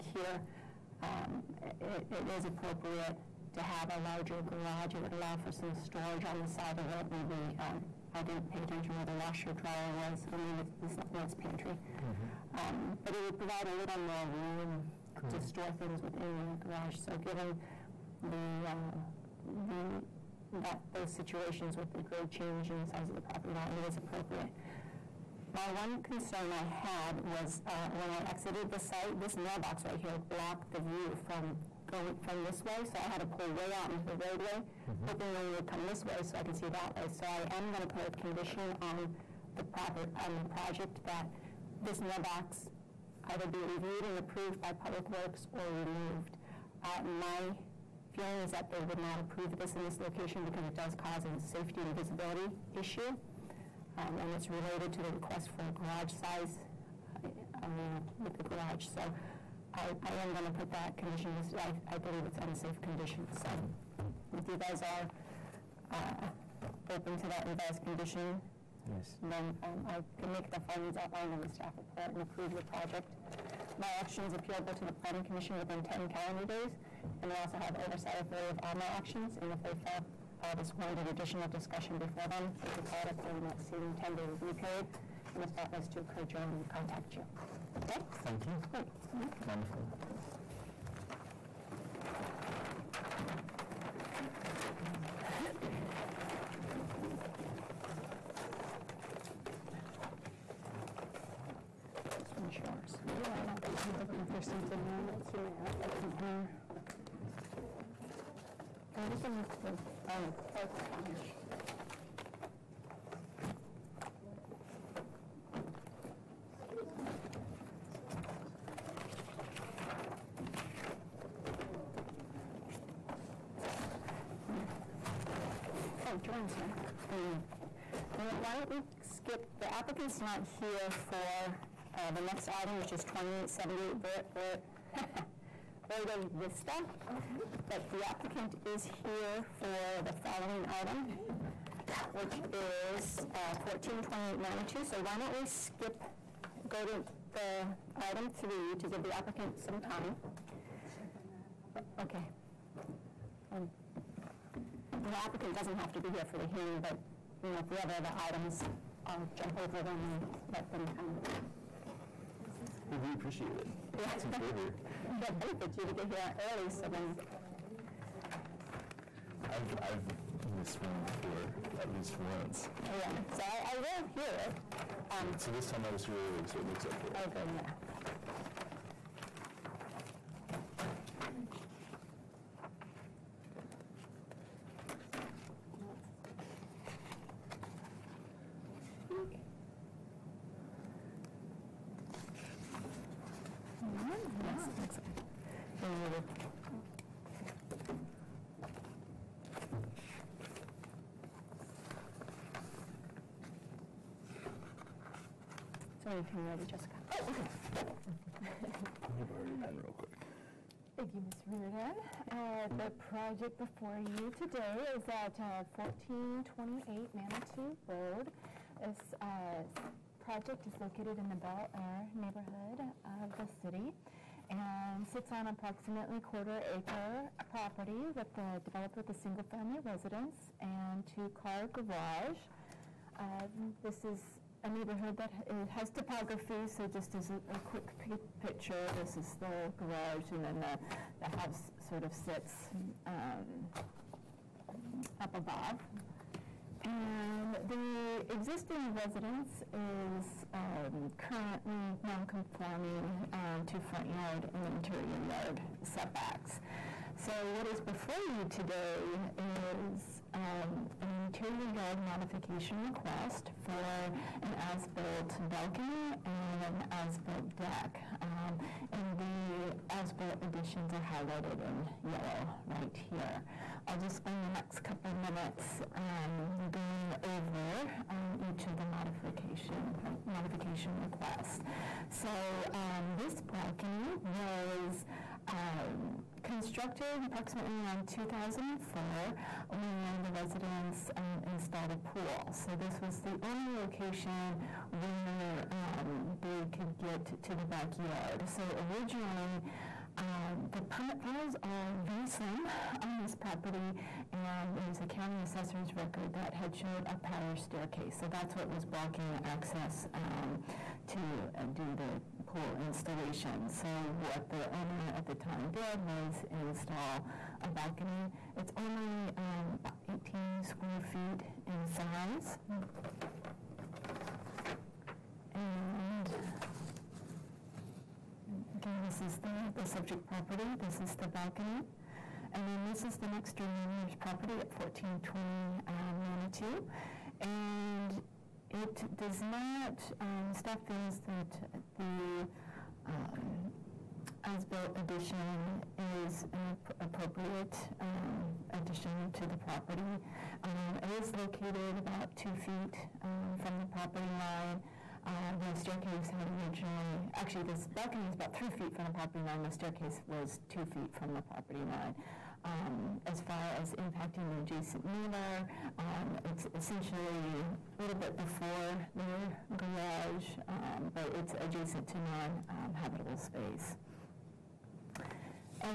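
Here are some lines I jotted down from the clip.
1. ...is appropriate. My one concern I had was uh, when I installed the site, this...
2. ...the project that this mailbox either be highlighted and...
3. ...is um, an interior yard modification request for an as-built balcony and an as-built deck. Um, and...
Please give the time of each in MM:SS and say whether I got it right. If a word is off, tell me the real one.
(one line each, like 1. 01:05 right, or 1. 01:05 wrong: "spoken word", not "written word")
1. 00:23 wrong: "exited", not "installed"
2. 00:40 wrong: "reviewed", not "highlighted"
3. 04:19 right.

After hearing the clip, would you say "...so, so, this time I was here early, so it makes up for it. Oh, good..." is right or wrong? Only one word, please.
right.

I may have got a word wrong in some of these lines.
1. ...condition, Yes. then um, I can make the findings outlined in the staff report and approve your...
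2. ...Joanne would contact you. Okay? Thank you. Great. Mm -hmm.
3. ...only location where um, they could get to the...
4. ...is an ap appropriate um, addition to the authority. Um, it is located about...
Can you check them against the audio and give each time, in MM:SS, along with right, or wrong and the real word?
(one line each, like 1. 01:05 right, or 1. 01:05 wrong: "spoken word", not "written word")
1. 01:07 right
2. 01:26 right
3. 04:53 right
4. 05:45 wrong: "property", not "authority".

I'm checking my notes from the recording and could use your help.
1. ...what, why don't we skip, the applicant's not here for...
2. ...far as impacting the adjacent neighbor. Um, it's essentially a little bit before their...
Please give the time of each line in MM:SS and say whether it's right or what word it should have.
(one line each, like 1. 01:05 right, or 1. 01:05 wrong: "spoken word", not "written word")
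1. 02:08 right
2. 06:03 right.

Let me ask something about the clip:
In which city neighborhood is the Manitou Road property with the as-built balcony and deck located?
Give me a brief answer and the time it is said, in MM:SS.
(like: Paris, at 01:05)
Bel Air, at 03:41.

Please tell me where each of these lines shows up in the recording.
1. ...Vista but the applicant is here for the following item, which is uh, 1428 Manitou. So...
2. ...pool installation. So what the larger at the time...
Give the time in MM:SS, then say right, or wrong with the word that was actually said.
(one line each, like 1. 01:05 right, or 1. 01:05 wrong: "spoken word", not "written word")
1. 02:16 right
2. 05:12 wrong: "owner", not "larger".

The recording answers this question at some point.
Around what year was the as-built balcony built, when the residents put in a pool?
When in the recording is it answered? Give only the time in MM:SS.
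04:48.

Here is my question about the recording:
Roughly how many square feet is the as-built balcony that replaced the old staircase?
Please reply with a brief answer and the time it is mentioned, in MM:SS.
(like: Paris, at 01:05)
18, at 05:20.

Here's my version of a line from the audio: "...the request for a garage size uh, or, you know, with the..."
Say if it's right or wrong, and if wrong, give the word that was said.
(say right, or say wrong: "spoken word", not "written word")
right.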